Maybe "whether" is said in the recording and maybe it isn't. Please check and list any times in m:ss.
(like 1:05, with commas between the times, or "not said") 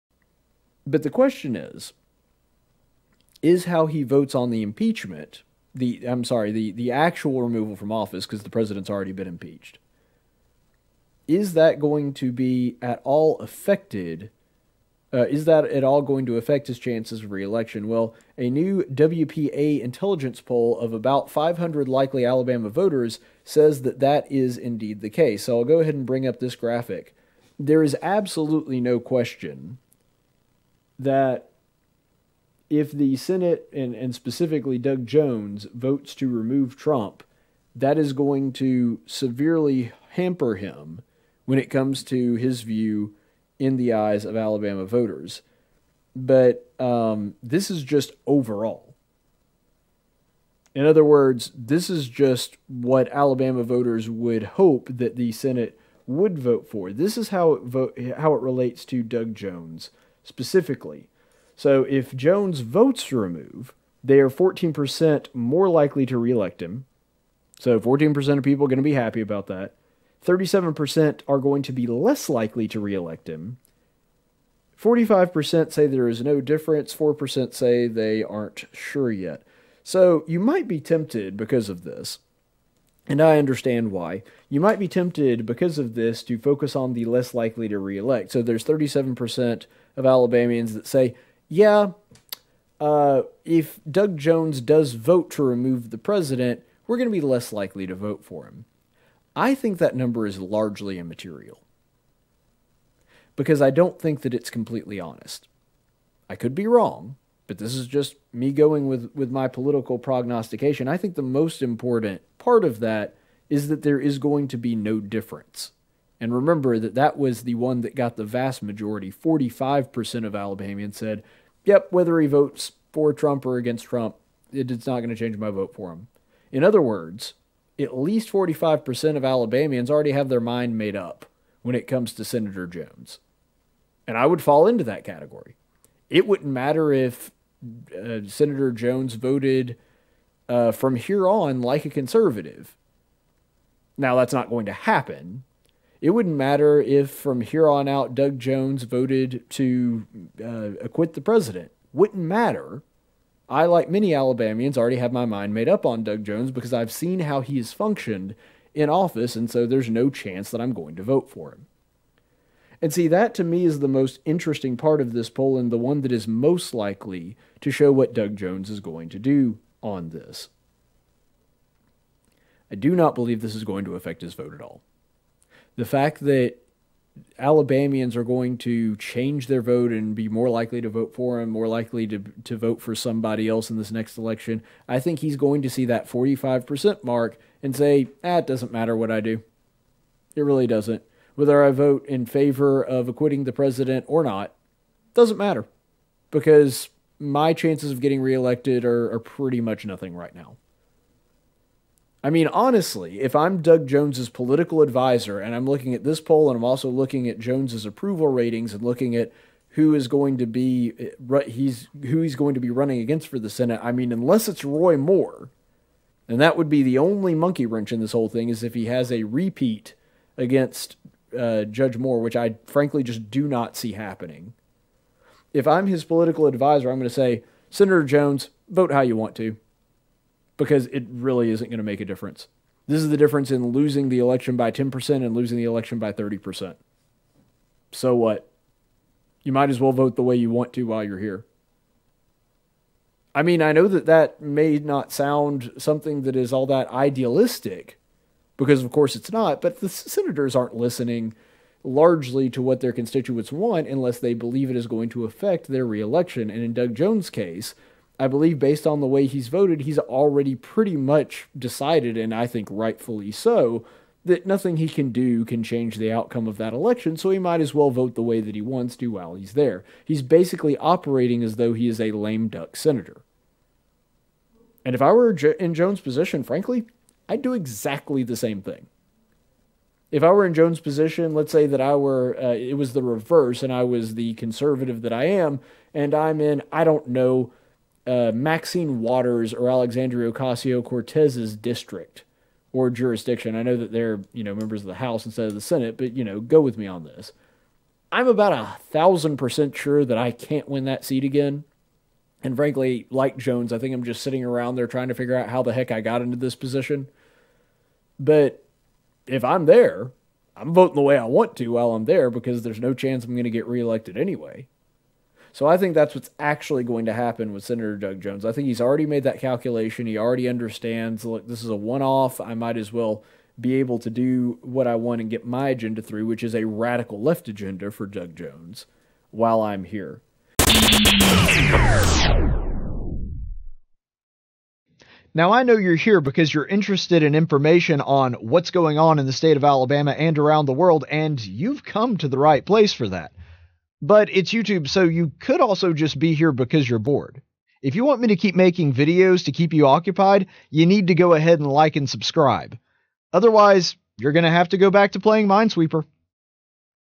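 2:01, 3:11.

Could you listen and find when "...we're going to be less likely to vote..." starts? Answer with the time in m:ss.
1:36.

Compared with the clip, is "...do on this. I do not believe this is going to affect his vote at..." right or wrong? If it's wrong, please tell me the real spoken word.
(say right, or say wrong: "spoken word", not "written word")
right.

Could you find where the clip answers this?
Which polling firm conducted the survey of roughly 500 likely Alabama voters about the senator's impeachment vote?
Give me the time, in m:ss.
0:18.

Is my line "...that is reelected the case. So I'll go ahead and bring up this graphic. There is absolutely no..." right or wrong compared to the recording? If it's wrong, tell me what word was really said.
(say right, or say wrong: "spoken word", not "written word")
wrong: "indeed", not "reelected".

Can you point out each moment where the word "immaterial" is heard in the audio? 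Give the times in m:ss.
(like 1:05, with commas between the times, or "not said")
1:40.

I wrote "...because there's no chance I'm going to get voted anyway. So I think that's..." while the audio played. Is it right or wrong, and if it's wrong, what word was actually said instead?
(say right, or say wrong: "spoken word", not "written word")
wrong: "reelected", not "voted".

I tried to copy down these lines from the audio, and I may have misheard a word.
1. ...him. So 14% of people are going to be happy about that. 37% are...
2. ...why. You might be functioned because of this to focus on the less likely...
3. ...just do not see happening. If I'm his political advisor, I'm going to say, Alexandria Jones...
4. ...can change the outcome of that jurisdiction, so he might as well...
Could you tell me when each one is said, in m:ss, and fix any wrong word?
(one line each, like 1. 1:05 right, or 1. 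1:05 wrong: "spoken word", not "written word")
1. 1:06 right
2. 1:23 wrong: "tempted", not "functioned"
3. 3:43 wrong: "Senator", not "Alexandria"
4. 4:25 wrong: "election", not "jurisdiction".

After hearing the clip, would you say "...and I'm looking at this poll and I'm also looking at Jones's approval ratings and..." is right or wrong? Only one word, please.
right.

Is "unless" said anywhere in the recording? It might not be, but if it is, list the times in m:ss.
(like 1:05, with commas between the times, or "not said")
3:34, 4:13.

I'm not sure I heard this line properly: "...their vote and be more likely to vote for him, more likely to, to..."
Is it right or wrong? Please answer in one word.
right.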